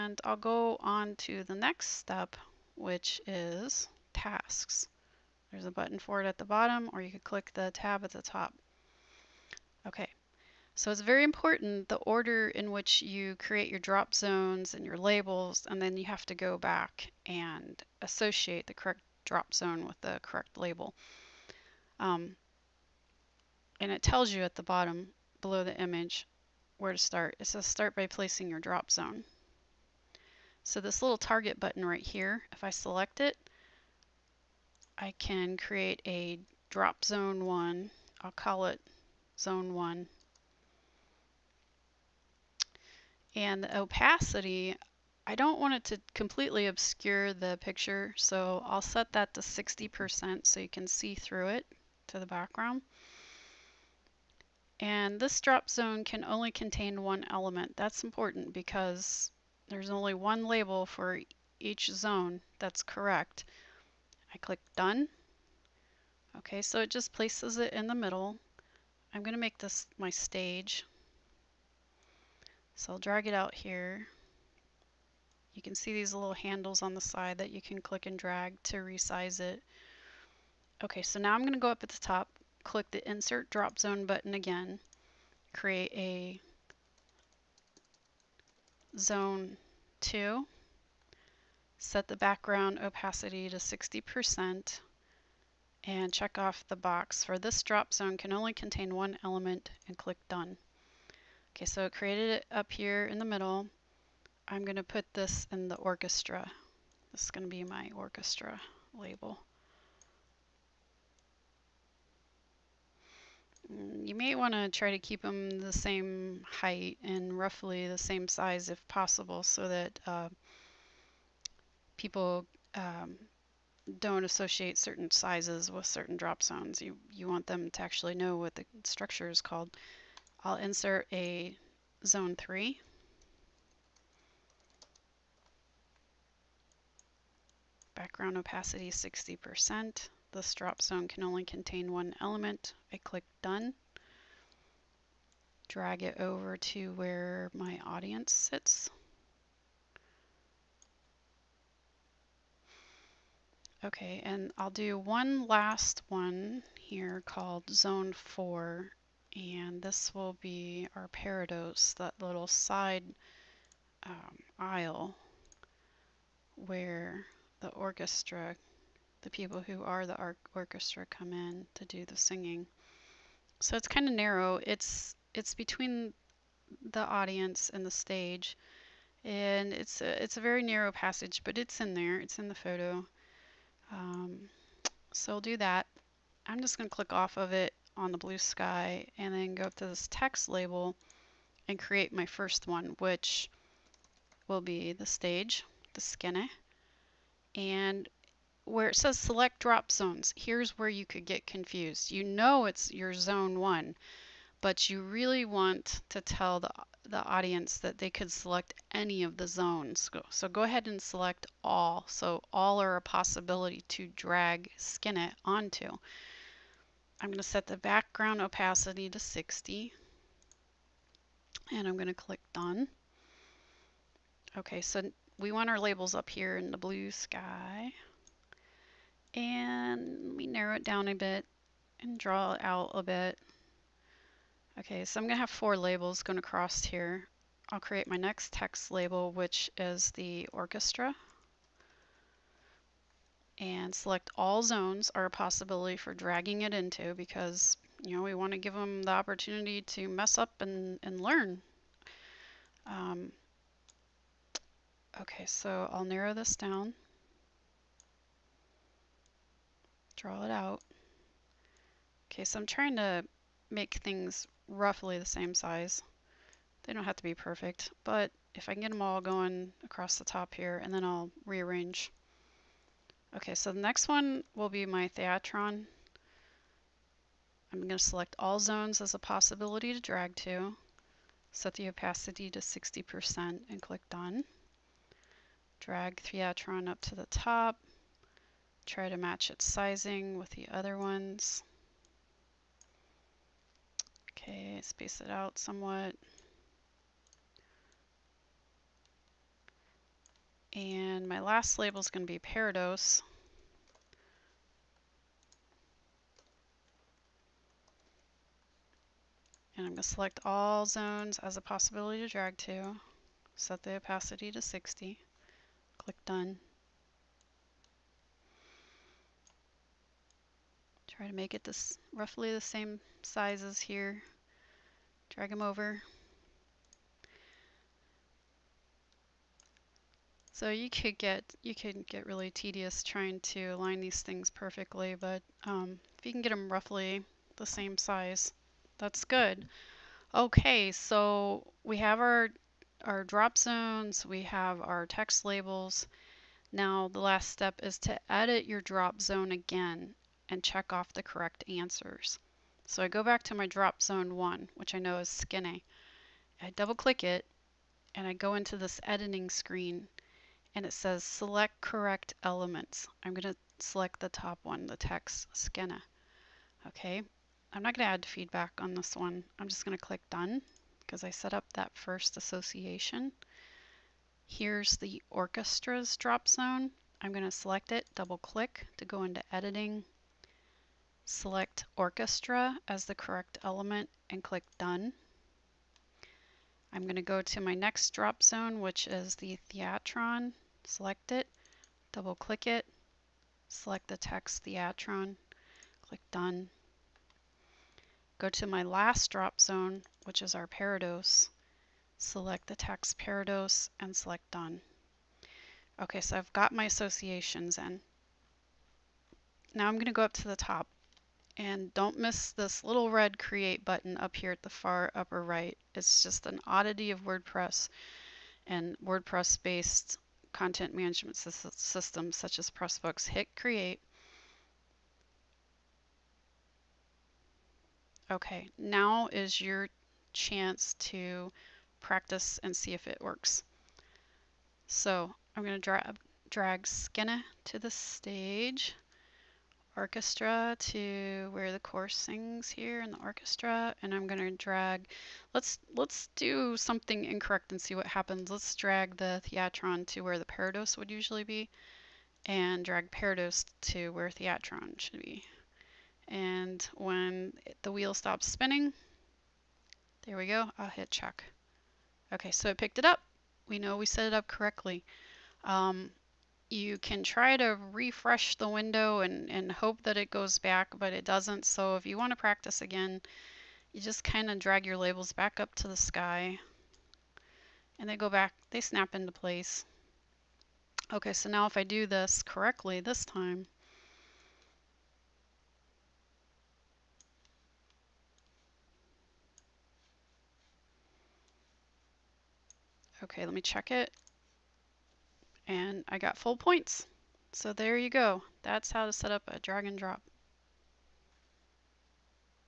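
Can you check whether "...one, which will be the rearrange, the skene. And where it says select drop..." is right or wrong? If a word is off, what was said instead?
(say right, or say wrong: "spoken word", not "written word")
wrong: "stage", not "rearrange".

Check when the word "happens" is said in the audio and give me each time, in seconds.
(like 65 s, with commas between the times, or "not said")
448 s.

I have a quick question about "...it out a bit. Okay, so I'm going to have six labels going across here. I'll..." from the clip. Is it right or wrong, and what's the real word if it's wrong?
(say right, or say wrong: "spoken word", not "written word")
wrong: "four", not "six".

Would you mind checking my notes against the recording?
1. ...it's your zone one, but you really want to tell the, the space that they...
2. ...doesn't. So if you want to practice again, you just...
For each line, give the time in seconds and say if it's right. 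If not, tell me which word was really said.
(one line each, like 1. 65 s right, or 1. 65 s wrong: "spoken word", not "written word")
1. 202 s wrong: "audience", not "space"
2. 471 s right.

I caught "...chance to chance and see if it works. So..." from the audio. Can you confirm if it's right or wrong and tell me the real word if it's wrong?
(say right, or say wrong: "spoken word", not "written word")
wrong: "practice", not "chance".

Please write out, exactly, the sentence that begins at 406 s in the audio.
Okay, so I've got my associations in.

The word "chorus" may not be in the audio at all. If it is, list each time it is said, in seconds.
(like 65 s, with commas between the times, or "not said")
441 s.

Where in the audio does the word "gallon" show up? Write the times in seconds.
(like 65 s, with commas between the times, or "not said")
not said.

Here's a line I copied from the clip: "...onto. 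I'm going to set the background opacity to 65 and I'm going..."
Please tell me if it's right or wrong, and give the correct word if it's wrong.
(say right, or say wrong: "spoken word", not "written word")
wrong: "60", not "65".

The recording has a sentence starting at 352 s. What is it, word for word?
So I go back to my drop zone one, which I know is skene.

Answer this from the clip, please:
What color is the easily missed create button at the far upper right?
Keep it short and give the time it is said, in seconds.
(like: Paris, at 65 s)
red, at 413 s.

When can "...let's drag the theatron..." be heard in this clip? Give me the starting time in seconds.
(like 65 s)
448 s.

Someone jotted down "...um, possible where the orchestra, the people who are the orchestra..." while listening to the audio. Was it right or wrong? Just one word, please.
wrong.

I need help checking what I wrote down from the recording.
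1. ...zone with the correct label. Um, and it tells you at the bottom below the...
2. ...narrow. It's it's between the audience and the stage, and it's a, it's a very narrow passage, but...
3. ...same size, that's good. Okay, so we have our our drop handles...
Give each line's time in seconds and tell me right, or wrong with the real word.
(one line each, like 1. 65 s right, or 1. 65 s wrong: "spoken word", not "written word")
1. 19 s right
2. 174 s right
3. 337 s wrong: "zones", not "handles".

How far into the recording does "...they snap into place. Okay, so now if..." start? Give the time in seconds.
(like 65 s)
478 s.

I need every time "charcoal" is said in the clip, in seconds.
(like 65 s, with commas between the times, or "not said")
not said.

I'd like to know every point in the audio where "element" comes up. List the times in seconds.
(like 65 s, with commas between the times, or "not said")
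57 s, 99 s, 142 s, 362 s, 383 s.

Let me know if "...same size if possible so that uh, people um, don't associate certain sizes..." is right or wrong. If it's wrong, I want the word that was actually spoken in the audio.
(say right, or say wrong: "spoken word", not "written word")
right.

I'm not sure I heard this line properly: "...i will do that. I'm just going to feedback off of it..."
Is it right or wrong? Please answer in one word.
wrong.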